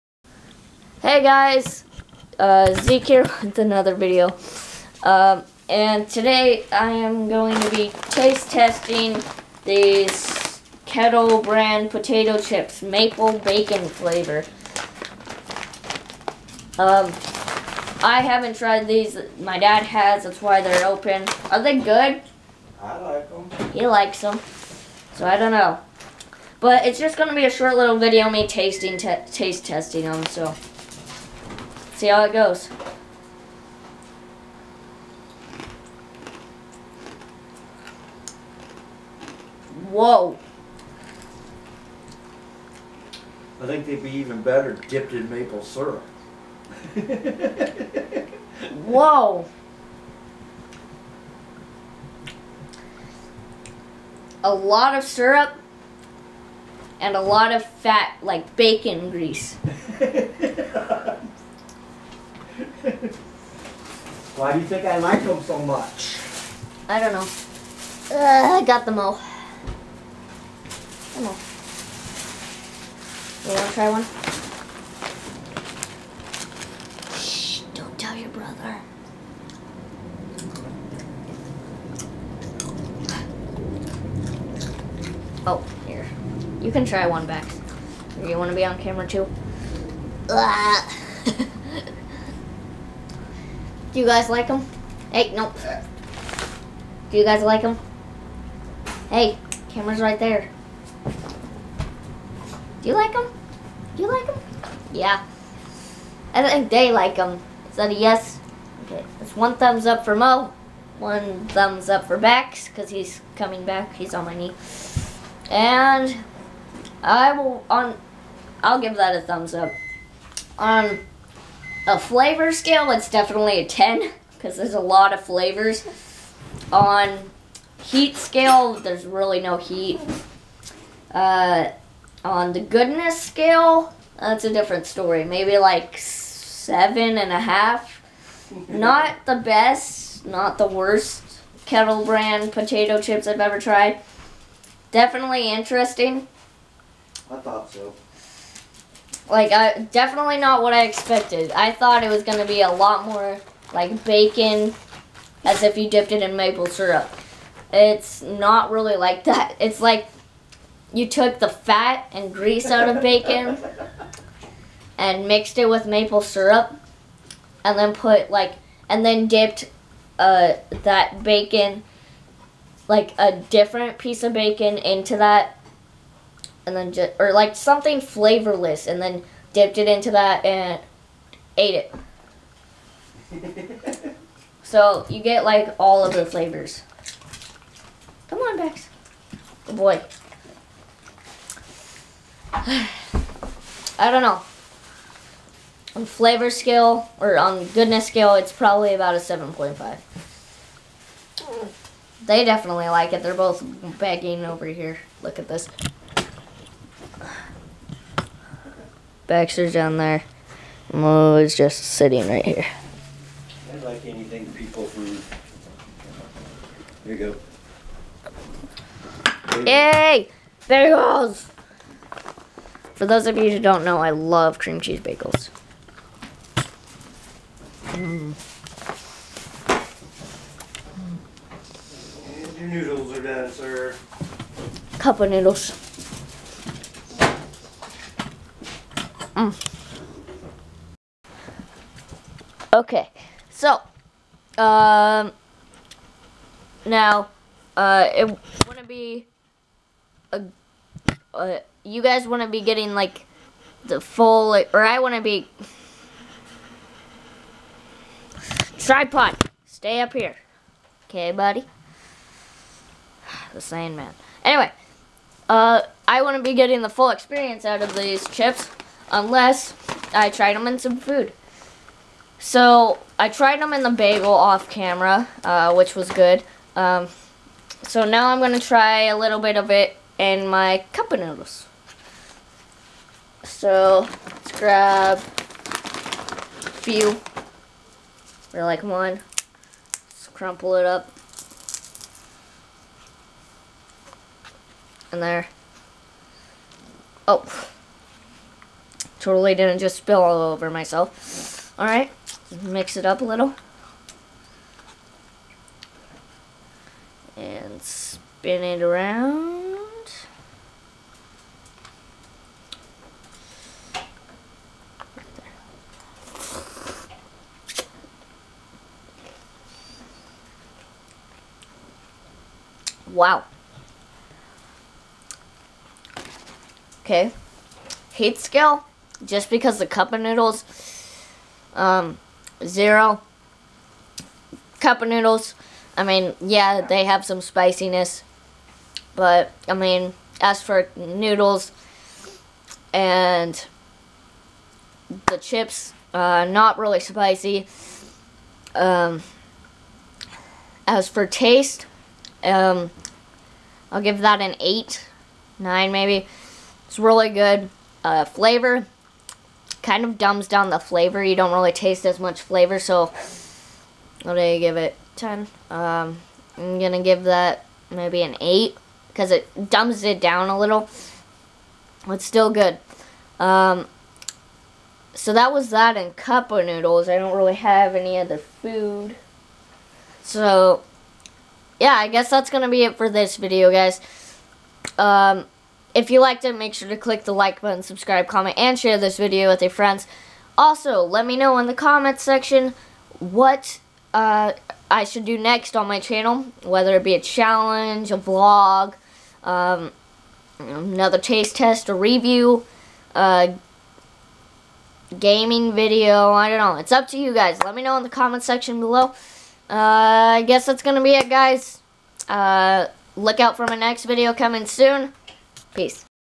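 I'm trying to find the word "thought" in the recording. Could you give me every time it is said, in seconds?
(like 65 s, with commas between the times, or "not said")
147 s, 151 s.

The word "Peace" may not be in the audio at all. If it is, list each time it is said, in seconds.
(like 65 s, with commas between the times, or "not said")
415 s.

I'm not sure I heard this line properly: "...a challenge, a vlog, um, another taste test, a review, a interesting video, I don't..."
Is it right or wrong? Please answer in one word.
wrong.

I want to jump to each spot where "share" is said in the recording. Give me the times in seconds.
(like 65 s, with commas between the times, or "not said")
388 s.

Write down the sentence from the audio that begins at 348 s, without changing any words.
Um, as for taste, um, I'll give that an 8, 9 maybe.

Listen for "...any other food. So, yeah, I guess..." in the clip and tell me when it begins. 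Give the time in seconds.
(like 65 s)
377 s.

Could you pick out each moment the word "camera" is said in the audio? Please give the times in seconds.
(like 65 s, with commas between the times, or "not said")
88 s, 99 s, 274 s.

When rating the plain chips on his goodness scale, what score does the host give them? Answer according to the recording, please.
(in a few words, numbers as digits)
7.5.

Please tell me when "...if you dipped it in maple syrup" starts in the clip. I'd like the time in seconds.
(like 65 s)
155 s.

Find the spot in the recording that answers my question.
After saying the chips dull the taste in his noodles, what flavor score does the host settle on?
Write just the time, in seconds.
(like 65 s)
367 s.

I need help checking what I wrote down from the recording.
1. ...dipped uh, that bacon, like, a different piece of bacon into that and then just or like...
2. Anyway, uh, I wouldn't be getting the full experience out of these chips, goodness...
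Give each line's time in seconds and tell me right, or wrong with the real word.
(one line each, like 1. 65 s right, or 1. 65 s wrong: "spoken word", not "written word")
1. 169 s right
2. 264 s wrong: "unless", not "goodness".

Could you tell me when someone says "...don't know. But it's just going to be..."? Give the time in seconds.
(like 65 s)
25 s.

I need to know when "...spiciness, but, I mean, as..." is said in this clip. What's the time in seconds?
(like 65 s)
337 s.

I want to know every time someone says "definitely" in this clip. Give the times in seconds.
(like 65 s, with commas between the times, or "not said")
123 s, 144 s, 149 s, 202 s.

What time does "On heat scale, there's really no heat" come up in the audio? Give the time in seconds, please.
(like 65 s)
126 s.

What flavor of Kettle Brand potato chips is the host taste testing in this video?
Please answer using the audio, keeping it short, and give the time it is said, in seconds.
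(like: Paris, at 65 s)
maple bacon, at 12 s.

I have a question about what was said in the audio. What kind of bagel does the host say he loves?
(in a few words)
cream cheese bagels.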